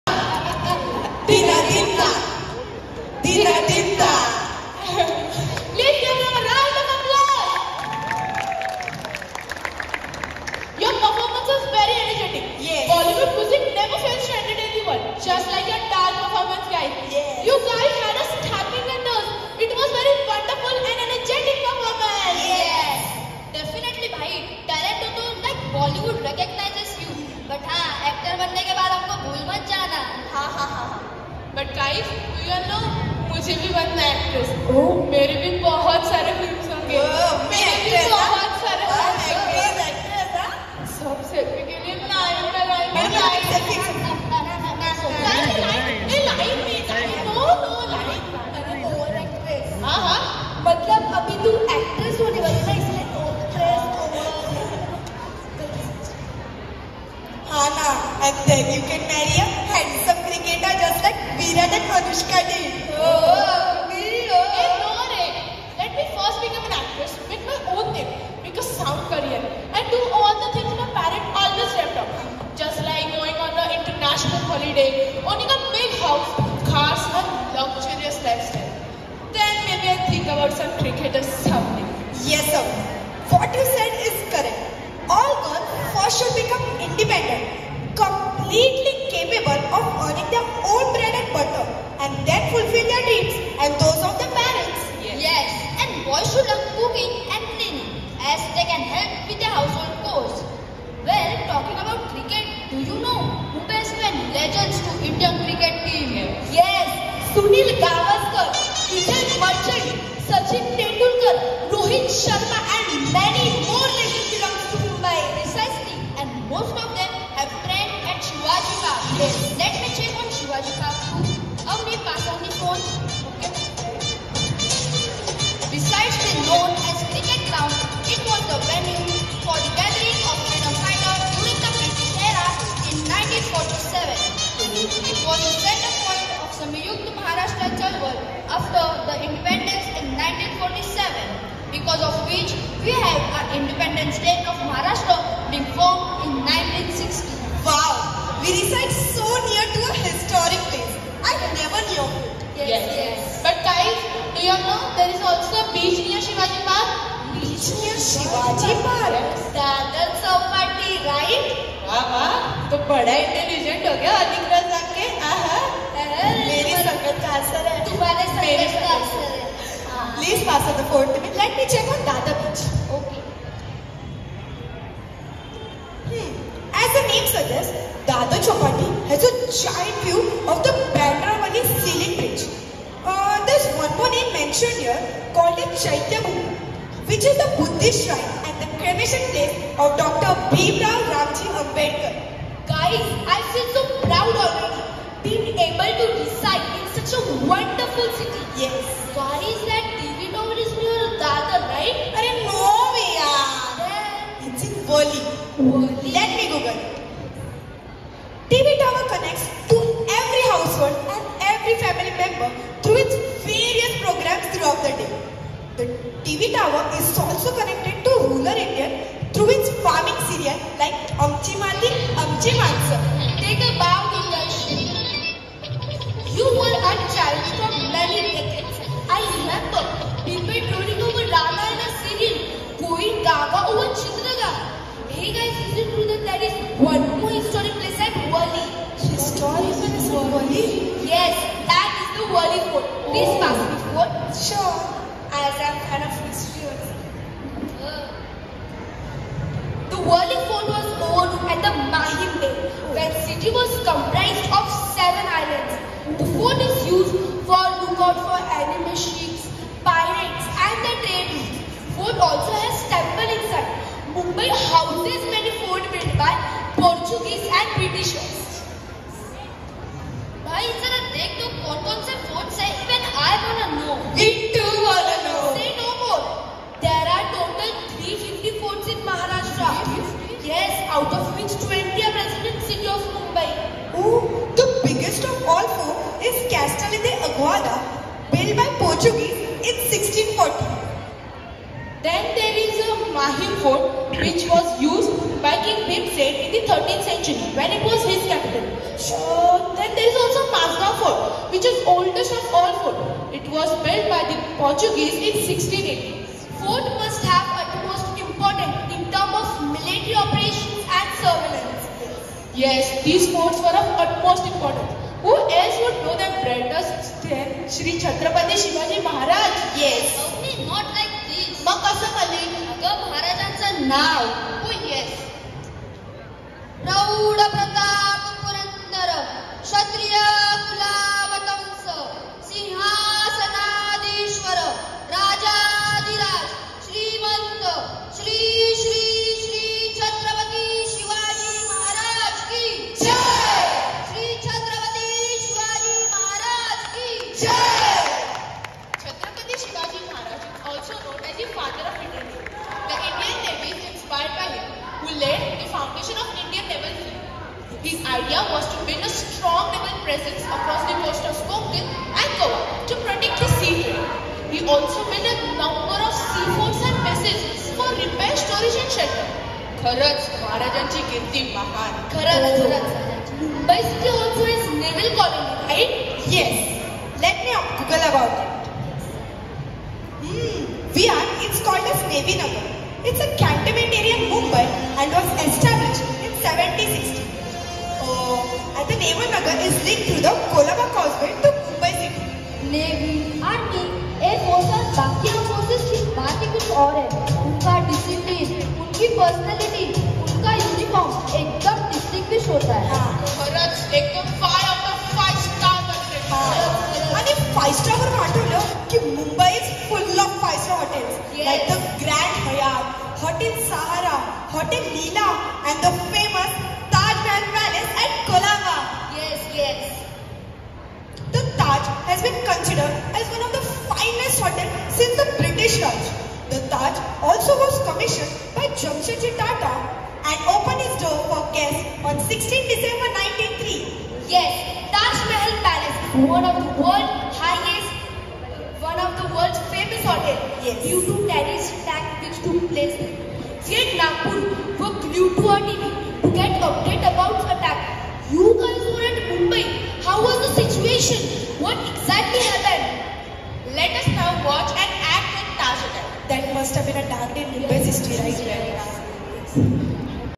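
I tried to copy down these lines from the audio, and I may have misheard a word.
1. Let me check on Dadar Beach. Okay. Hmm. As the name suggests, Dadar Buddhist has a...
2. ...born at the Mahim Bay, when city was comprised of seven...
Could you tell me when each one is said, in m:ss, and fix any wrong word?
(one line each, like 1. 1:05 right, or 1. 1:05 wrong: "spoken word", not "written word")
1. 2:51 wrong: "Chowpatty", not "Buddhist"
2. 4:10 right.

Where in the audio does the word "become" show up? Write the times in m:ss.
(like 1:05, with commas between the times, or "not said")
1:06, 1:26.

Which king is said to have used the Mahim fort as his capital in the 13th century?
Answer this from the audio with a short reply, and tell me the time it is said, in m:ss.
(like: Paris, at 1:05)
King Bhimsen, at 4:55.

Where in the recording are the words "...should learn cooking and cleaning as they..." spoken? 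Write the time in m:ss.
1:36.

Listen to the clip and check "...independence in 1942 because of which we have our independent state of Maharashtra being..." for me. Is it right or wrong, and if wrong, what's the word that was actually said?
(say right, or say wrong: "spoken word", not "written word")
wrong: "1947", not "1942".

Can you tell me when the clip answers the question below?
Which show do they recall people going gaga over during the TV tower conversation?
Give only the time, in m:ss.
3:53.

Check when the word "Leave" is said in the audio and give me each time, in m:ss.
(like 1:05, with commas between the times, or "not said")
0:04.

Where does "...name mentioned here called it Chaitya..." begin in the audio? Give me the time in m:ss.
3:04.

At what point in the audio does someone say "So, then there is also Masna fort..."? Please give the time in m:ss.
4:59.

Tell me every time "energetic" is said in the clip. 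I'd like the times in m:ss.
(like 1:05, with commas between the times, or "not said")
0:12, 0:21.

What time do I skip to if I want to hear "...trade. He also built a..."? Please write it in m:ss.
6:03.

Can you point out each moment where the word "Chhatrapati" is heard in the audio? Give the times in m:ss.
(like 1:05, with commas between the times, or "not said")
5:18.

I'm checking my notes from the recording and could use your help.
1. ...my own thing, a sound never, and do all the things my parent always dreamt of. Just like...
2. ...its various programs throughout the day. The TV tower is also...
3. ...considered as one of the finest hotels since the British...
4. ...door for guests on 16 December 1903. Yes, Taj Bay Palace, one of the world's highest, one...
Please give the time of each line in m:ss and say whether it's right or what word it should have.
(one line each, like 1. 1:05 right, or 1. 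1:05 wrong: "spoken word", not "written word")
1. 1:07 wrong: "career", not "never"
2. 3:32 right
3. 7:02 right
4. 7:10 wrong: "Mahal", not "Bay".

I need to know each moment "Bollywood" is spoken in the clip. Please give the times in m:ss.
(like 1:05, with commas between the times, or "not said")
0:12, 0:25.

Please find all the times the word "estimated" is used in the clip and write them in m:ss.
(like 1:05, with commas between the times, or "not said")
not said.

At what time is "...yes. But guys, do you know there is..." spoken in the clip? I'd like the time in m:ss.
2:32.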